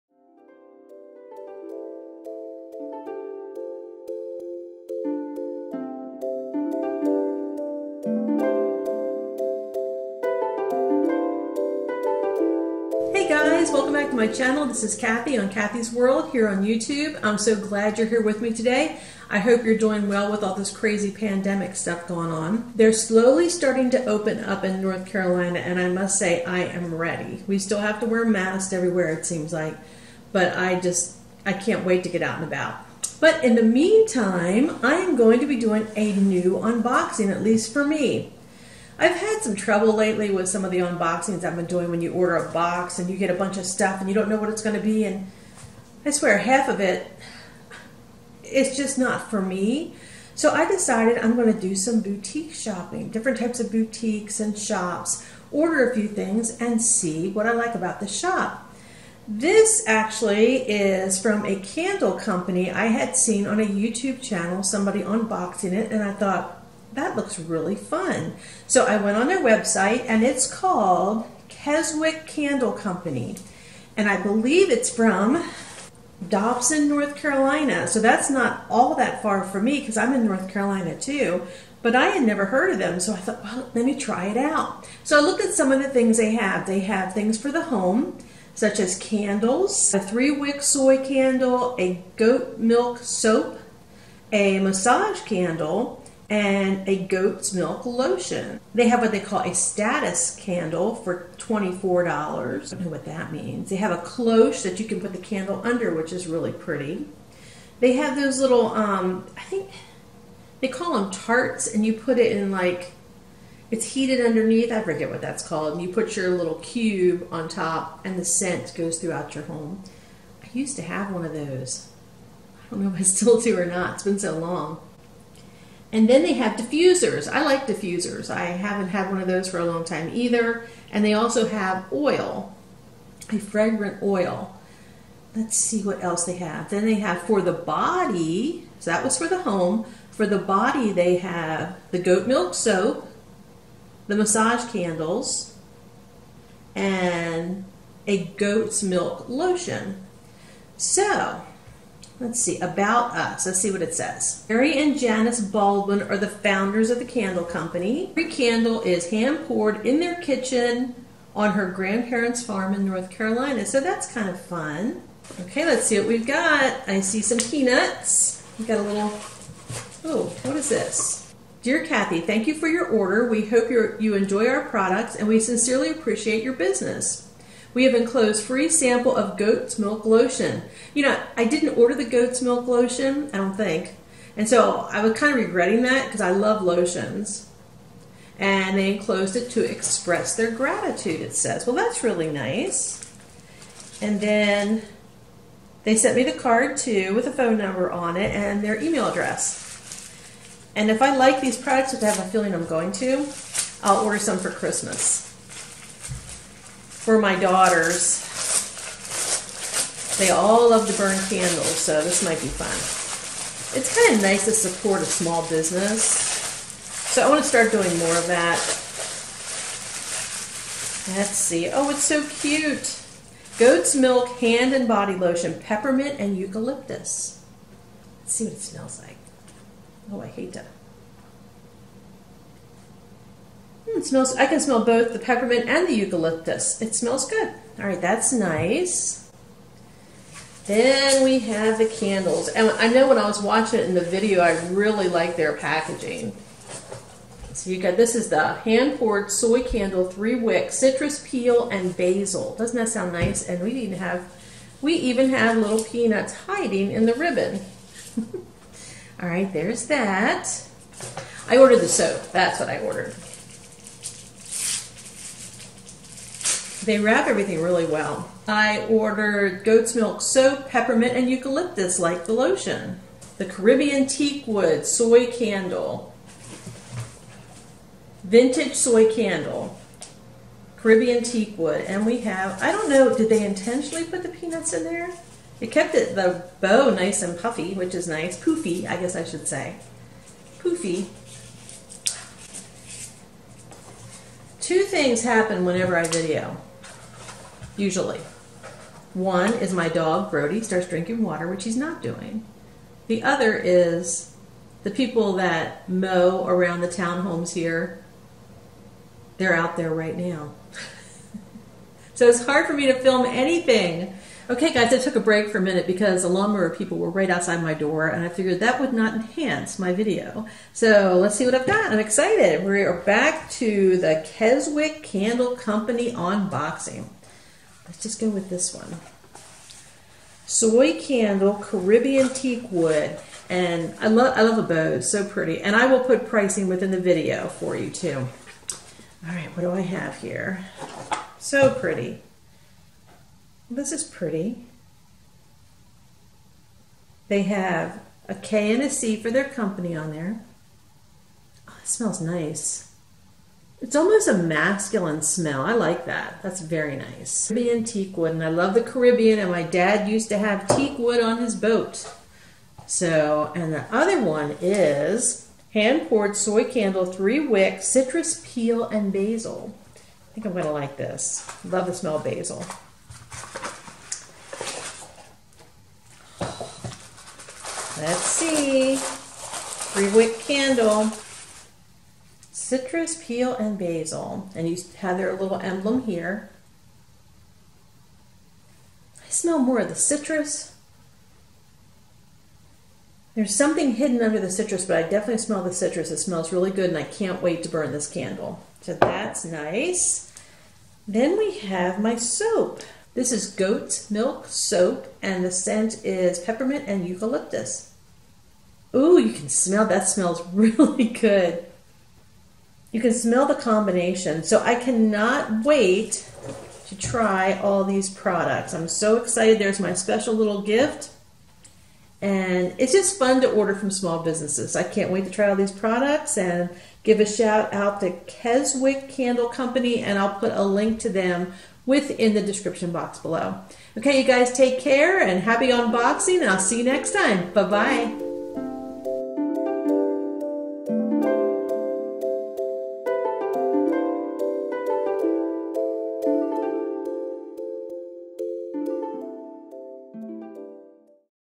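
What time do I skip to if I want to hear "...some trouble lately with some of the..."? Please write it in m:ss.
0:39.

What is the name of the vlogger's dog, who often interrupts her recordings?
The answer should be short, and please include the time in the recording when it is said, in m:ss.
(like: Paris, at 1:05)
Brody, at 5:00.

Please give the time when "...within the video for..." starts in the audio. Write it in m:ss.
5:36.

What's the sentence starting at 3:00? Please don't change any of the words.
You know, I didn't order the goat's milk lotion, I don't think.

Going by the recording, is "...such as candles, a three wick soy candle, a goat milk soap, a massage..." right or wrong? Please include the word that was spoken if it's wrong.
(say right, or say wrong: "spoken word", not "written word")
right.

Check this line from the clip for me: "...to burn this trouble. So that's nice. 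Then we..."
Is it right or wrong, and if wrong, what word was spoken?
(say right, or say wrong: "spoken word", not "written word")
wrong: "candle", not "trouble".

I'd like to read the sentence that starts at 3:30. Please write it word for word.
They all love to burn candles, so this might be fun.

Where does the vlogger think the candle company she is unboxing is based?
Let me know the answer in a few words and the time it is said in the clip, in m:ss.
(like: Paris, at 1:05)
Dobson, North Carolina, at 1:16.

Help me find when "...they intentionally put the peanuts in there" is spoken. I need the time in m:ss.
4:43.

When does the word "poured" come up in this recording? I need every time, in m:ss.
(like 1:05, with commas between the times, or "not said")
2:39, 4:08, 6:06.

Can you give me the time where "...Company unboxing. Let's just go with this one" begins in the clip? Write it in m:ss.
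5:25.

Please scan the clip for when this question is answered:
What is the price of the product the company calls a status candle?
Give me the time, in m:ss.
1:41.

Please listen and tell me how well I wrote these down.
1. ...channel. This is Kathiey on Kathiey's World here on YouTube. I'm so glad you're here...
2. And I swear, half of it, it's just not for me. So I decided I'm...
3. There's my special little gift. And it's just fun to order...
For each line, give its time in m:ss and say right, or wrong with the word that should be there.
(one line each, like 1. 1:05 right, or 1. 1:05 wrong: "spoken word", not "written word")
1. 0:14 right
2. 0:45 right
3. 6:59 right.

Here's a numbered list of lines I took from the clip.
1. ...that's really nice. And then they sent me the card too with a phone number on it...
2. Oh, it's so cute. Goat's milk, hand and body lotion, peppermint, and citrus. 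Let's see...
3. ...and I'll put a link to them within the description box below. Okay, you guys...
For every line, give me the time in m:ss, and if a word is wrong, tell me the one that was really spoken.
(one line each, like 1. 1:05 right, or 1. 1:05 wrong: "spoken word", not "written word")
1. 3:11 right
2. 3:41 wrong: "eucalyptus", not "citrus"
3. 7:10 right.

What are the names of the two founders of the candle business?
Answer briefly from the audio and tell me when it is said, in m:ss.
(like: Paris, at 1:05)
Mary and Janice Baldwin, at 2:34.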